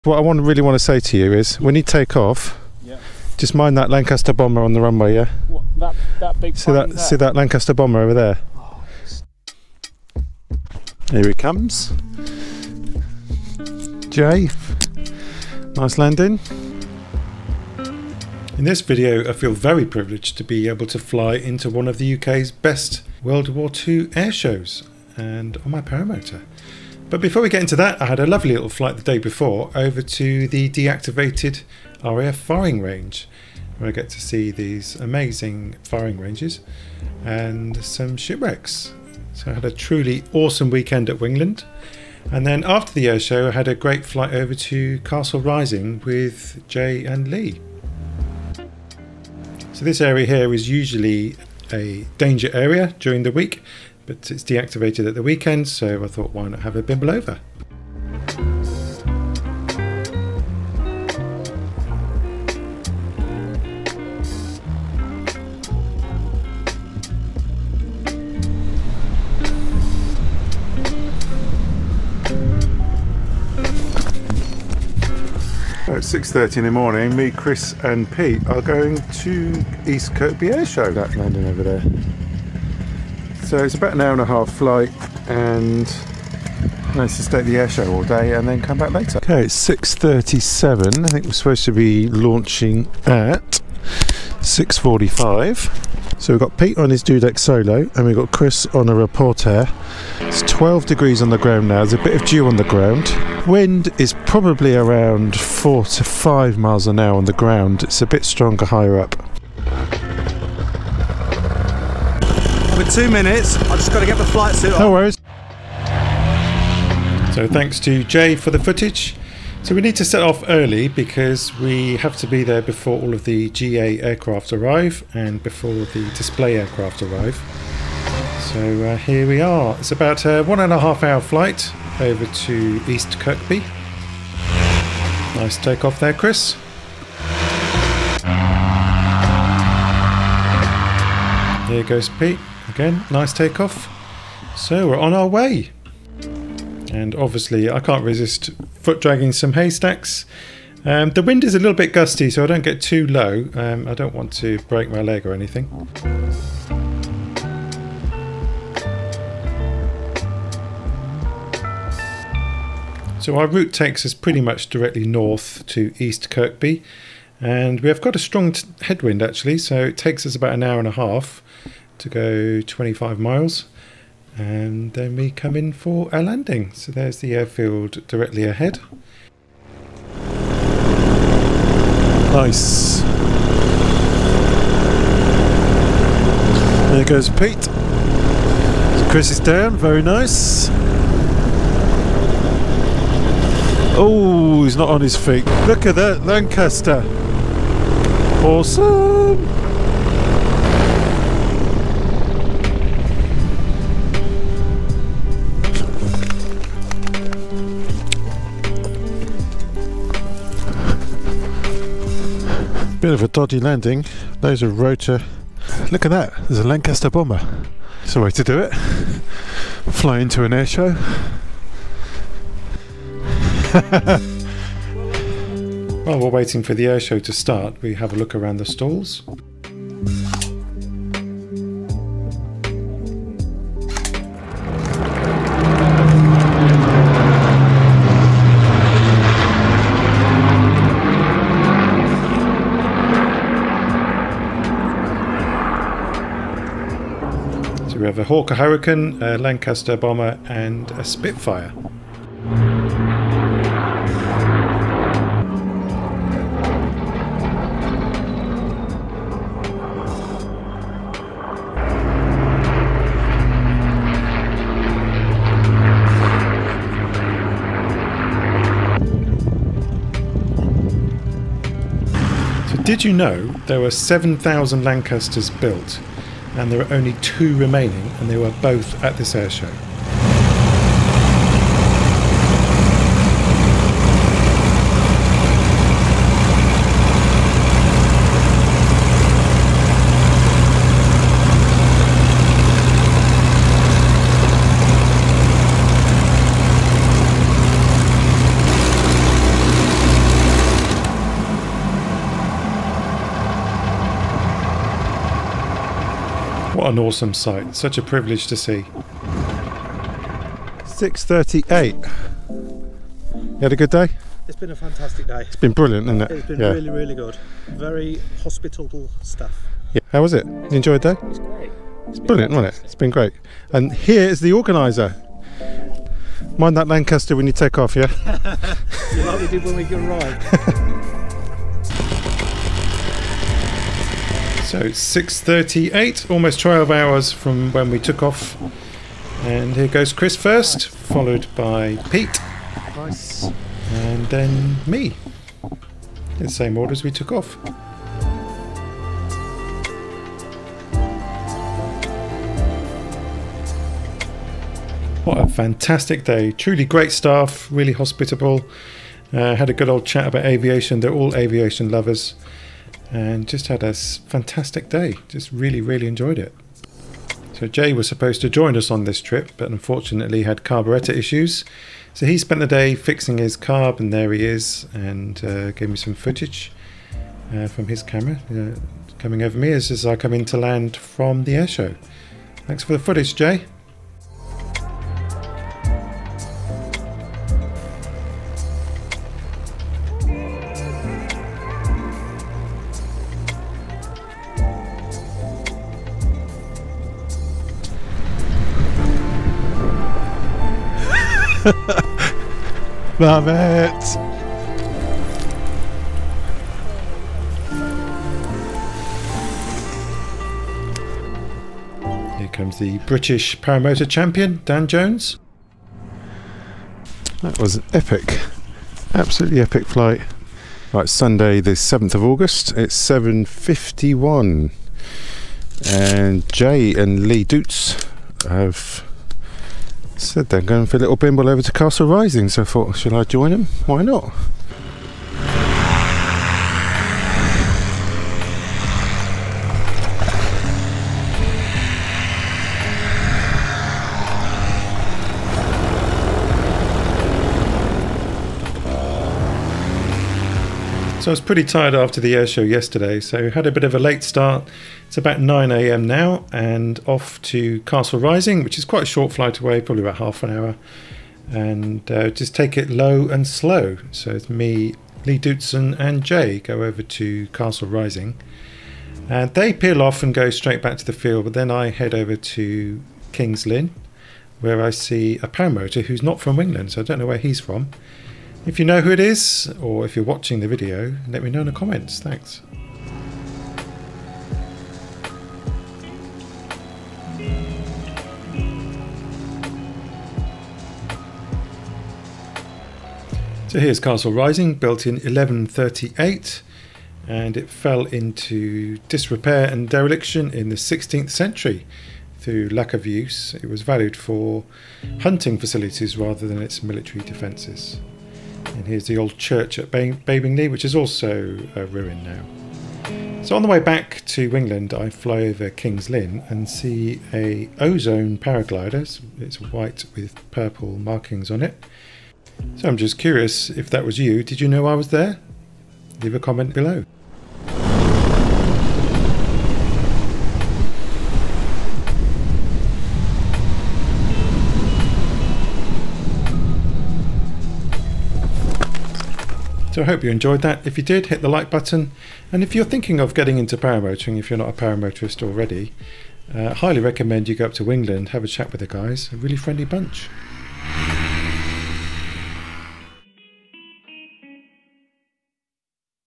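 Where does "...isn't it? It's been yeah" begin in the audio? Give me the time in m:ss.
5:16.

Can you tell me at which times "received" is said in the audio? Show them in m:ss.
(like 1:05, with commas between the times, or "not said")
not said.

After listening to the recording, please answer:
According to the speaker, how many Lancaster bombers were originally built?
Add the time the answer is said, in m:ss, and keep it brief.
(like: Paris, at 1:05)
7,000, at 4:33.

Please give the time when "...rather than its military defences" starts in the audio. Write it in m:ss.
8:26.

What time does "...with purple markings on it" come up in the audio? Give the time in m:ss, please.
8:40.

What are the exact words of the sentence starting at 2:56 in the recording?
So there's the airfield directly ahead.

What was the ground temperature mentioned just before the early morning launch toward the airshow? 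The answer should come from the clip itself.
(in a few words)
12 degrees.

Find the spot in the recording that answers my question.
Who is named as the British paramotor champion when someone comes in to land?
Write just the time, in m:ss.
6:54.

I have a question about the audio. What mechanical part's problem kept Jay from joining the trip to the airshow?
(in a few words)
carburetor.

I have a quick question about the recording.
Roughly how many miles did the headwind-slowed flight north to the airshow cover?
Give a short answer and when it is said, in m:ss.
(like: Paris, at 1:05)
25 miles, at 2:52.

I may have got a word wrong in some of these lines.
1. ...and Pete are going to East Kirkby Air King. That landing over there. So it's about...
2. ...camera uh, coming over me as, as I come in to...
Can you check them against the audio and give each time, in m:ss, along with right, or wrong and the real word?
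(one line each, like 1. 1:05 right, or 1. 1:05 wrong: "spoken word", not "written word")
1. 1:17 wrong: "Show", not "King"
2. 6:18 right.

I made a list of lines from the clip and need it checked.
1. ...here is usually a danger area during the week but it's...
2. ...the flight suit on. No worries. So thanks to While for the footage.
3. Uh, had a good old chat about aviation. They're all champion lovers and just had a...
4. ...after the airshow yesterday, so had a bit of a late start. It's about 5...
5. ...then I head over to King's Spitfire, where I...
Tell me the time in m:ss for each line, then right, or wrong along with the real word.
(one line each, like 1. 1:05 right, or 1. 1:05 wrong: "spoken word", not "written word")
1. 0:50 right
2. 1:54 wrong: "Jay", not "While"
3. 5:59 wrong: "aviation", not "champion"
4. 7:31 wrong: "9", not "5"
5. 7:51 wrong: "Lynn", not "Spitfire".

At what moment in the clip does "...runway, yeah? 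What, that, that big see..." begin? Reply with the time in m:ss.
0:04.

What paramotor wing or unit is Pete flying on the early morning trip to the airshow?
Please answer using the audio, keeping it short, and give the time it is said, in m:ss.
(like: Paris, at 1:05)
Dudek solo, at 1:37.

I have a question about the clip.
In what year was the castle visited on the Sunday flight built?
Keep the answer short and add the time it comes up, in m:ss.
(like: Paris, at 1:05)
1138, at 8:15.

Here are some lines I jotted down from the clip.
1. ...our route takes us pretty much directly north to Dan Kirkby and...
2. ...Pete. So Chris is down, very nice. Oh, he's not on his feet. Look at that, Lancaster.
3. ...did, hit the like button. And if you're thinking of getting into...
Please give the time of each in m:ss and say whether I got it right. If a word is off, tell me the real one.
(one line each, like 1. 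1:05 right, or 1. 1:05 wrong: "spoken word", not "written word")
1. 2:43 wrong: "East", not "Dan"
2. 3:07 right
3. 9:01 right.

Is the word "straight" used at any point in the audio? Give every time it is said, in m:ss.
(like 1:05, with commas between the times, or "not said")
7:50.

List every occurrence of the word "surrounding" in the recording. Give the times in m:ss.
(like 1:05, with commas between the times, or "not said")
not said.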